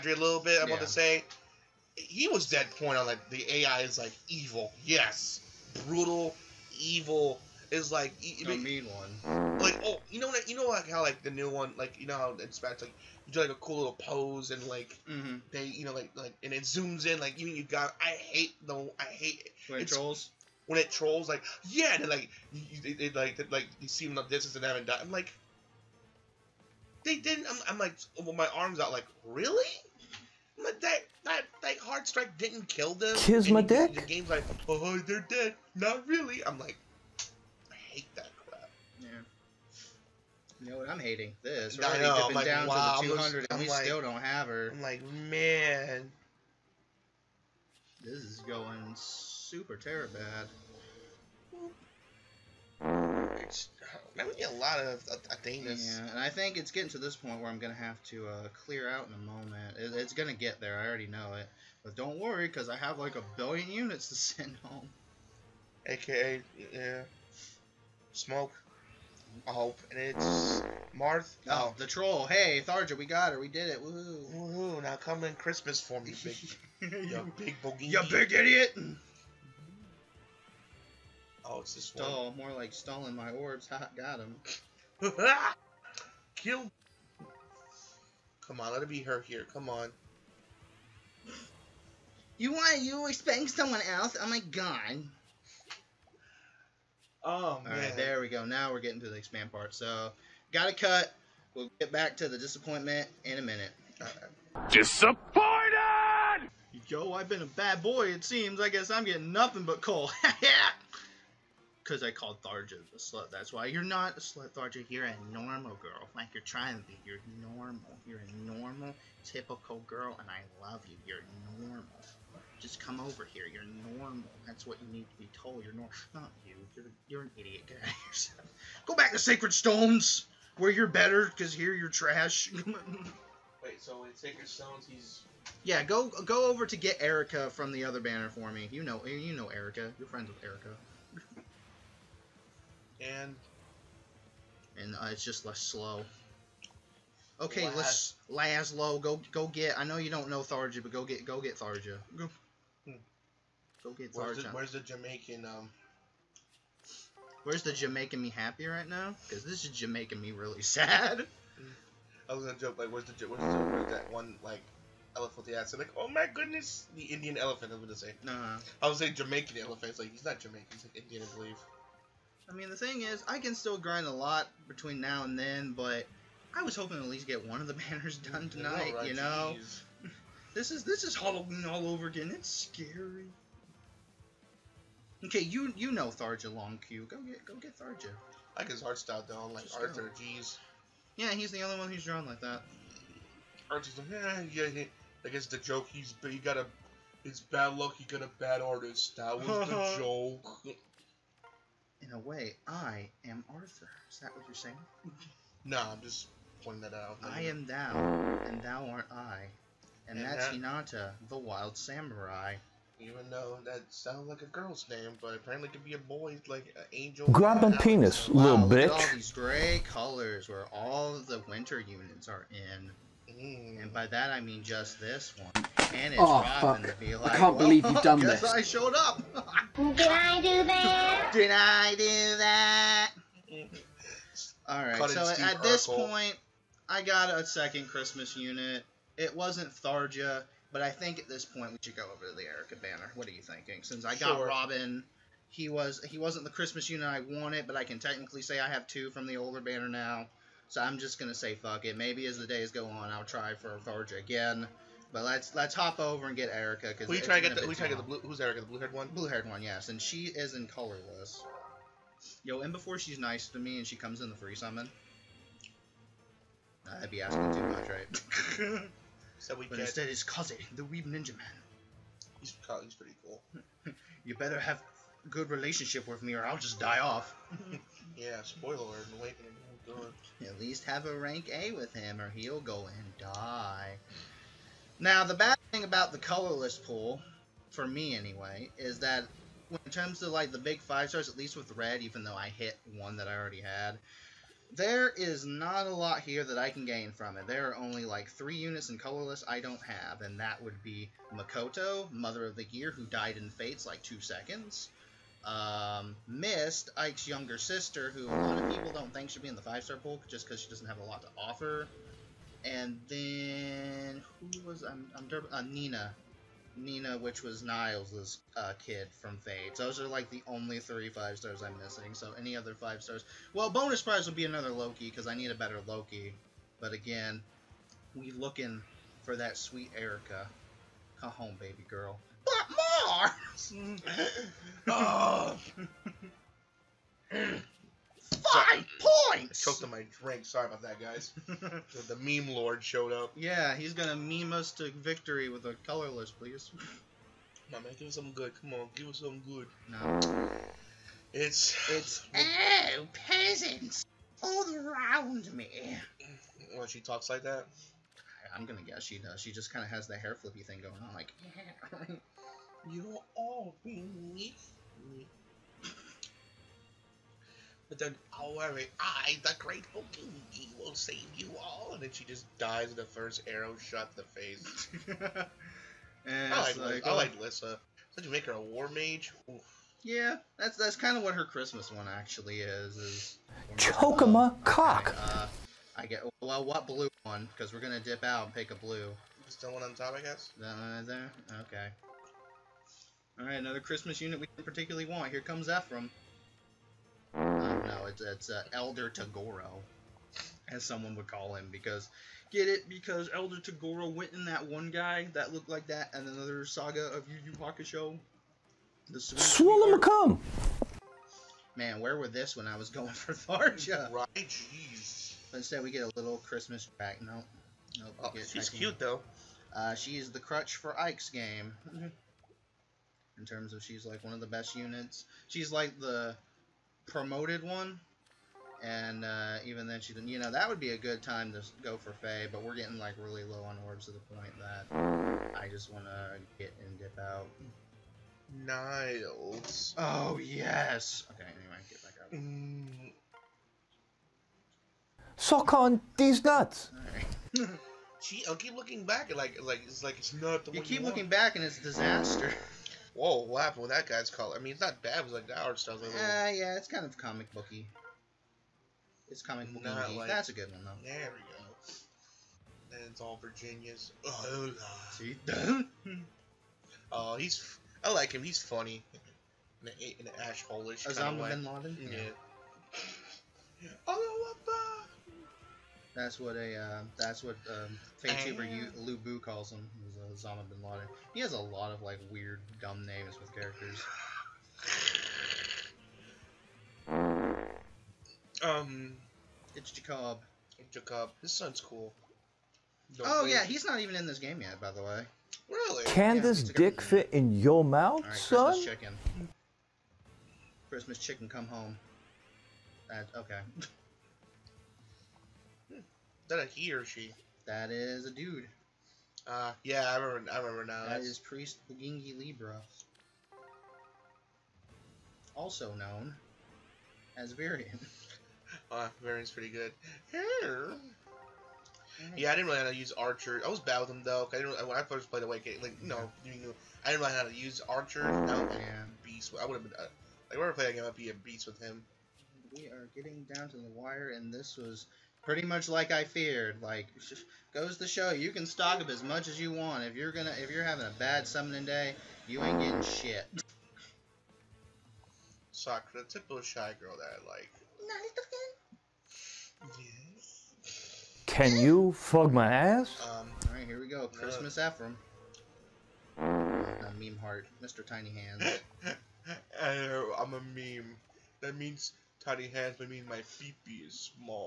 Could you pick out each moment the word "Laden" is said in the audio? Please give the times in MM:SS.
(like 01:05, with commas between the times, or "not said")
07:51, 08:00.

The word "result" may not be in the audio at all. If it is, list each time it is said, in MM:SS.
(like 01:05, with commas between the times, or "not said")
not said.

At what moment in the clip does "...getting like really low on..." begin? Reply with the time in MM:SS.
07:12.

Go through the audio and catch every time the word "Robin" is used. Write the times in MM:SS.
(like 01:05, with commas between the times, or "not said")
03:46, 04:04.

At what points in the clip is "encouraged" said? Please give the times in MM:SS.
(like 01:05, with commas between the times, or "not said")
not said.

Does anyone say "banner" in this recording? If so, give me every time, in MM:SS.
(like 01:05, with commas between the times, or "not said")
02:17, 02:57, 04:02, 04:09.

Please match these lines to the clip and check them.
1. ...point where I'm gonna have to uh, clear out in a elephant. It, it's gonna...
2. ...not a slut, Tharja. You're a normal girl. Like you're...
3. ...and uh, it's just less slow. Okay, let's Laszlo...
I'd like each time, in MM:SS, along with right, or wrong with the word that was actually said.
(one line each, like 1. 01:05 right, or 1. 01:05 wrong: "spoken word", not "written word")
1. 00:57 wrong: "moment", not "elephant"
2. 01:53 right
3. 02:24 right.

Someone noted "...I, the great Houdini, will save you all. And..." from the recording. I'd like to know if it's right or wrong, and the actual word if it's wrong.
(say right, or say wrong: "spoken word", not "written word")
right.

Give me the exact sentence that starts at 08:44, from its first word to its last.
Cause I didn't when I first played Awakening, like you know, I didn't really know how to use Archer.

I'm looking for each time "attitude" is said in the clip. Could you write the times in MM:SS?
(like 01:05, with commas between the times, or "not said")
not said.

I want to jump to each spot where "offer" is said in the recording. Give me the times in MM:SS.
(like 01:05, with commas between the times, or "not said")
05:11.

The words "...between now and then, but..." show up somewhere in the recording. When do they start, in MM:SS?
02:54.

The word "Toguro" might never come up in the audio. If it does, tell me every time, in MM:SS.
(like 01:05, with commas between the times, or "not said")
06:39, 06:43.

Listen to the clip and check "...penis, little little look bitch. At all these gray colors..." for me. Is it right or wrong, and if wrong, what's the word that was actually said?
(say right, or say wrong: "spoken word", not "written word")
right.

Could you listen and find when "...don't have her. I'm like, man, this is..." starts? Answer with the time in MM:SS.
00:44.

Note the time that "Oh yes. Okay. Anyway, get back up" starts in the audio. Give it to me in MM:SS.
07:19.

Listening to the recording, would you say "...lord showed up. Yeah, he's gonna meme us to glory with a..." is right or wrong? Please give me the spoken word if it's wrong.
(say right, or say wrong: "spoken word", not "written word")
wrong: "victory", not "glory".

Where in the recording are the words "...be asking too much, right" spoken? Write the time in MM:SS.
04:27.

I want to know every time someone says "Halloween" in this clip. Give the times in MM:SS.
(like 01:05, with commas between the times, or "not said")
03:01.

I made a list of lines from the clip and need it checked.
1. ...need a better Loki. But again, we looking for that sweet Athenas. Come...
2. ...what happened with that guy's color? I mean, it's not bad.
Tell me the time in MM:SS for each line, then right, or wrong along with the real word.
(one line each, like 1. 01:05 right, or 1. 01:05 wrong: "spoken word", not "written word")
1. 05:25 wrong: "Eirika", not "Athenas"
2. 07:33 right.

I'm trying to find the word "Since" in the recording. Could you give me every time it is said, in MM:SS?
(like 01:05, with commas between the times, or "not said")
04:03.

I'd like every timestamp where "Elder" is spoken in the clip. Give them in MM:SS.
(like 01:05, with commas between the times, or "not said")
06:38, 06:43.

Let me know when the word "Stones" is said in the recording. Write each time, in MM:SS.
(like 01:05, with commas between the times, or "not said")
02:09, 02:14.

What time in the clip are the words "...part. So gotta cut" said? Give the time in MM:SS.
01:39.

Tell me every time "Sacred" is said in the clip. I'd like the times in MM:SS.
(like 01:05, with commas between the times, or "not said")
02:09, 02:14.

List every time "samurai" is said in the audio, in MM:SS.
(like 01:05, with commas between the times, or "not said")
03:31.